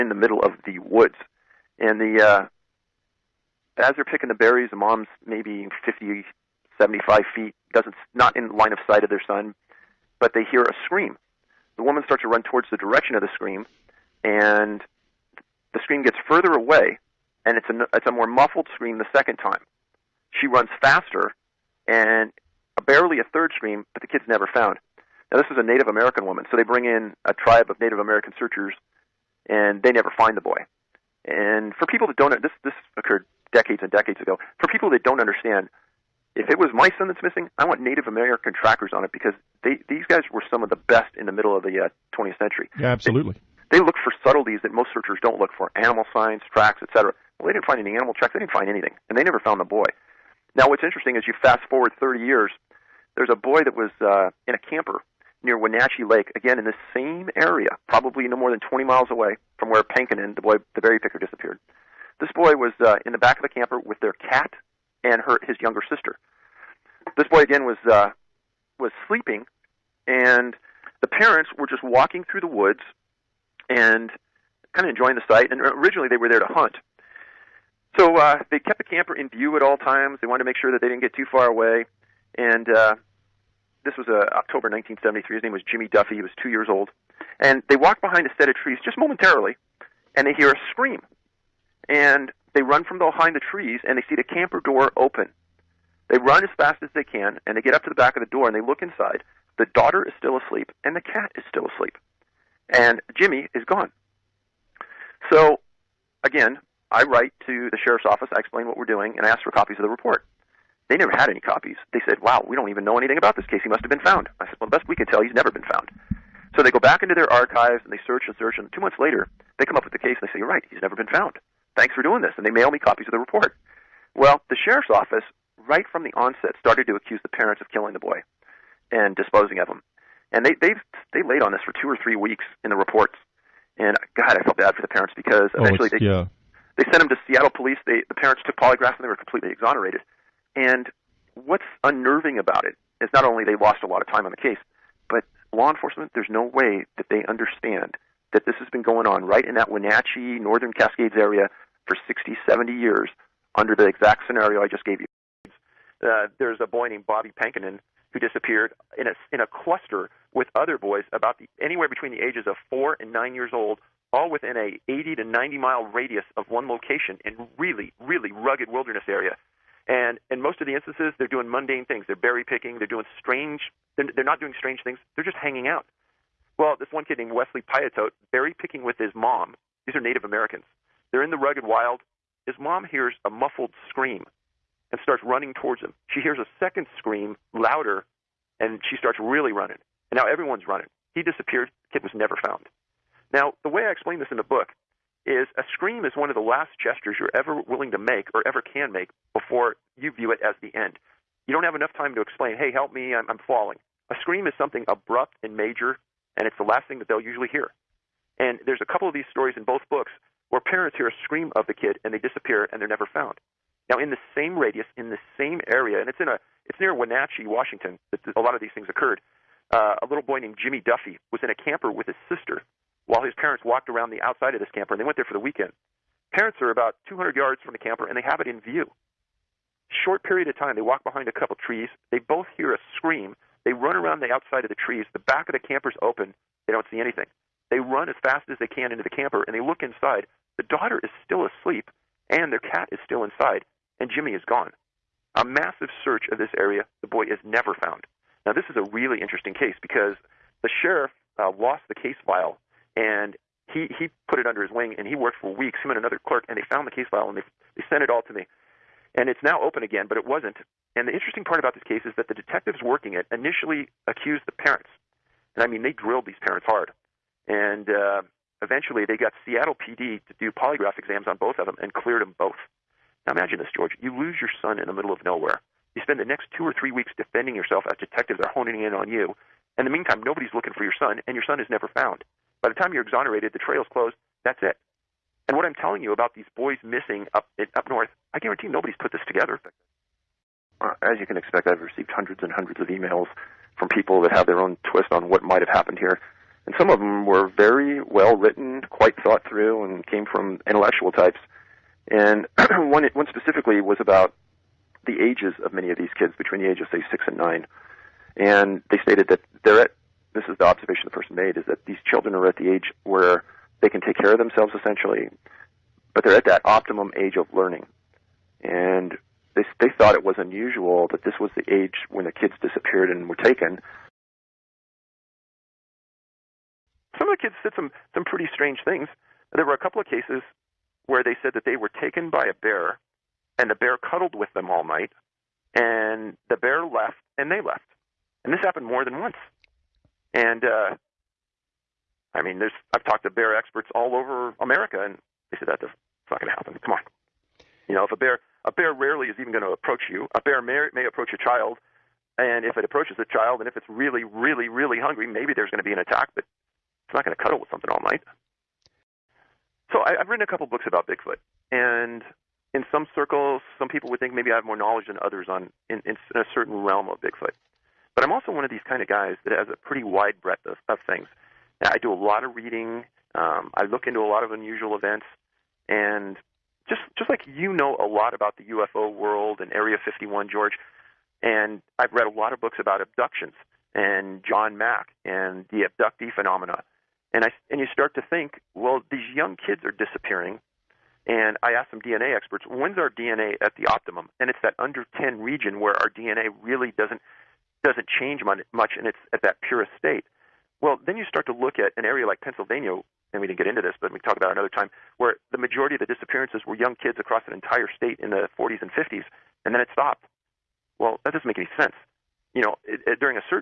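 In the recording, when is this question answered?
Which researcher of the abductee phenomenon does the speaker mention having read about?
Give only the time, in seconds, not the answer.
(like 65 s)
384 s.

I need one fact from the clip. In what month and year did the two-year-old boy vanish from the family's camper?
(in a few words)
October 1973.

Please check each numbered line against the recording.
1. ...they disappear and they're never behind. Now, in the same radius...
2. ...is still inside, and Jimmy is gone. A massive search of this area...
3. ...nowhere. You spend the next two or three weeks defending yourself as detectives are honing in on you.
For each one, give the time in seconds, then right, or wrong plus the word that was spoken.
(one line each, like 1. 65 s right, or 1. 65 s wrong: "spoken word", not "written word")
1. 212 s wrong: "found", not "behind"
2. 242 s right
3. 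275 s right.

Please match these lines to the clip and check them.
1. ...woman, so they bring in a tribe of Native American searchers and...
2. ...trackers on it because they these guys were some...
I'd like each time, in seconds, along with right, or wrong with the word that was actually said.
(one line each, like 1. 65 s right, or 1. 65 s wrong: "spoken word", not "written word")
1. 26 s right
2. 38 s right.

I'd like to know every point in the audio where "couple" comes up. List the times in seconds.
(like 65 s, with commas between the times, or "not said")
208 s, 231 s, 329 s, 360 s.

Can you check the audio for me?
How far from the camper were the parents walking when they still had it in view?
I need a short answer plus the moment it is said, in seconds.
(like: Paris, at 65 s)
200 yards, at 227 s.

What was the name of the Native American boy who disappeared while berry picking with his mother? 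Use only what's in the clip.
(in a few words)
Wesley Piatote.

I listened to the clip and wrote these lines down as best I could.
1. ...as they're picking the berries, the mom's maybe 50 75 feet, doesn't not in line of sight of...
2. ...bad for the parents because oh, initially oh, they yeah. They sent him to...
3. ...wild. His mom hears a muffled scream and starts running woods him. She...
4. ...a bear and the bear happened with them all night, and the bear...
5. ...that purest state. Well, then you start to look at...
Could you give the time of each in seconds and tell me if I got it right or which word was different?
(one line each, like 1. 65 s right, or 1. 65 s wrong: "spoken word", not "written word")
1. 3 s right
2. 134 s wrong: "eventually", not "initially"
3. 181 s wrong: "towards", not "woods"
4. 332 s wrong: "cuddled", not "happened"
5. 399 s right.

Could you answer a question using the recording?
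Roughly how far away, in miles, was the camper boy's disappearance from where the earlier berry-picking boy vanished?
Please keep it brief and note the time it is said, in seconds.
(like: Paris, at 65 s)
20 miles, at 58 s.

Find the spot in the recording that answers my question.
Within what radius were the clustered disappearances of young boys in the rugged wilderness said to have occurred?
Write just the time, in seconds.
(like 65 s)
164 s.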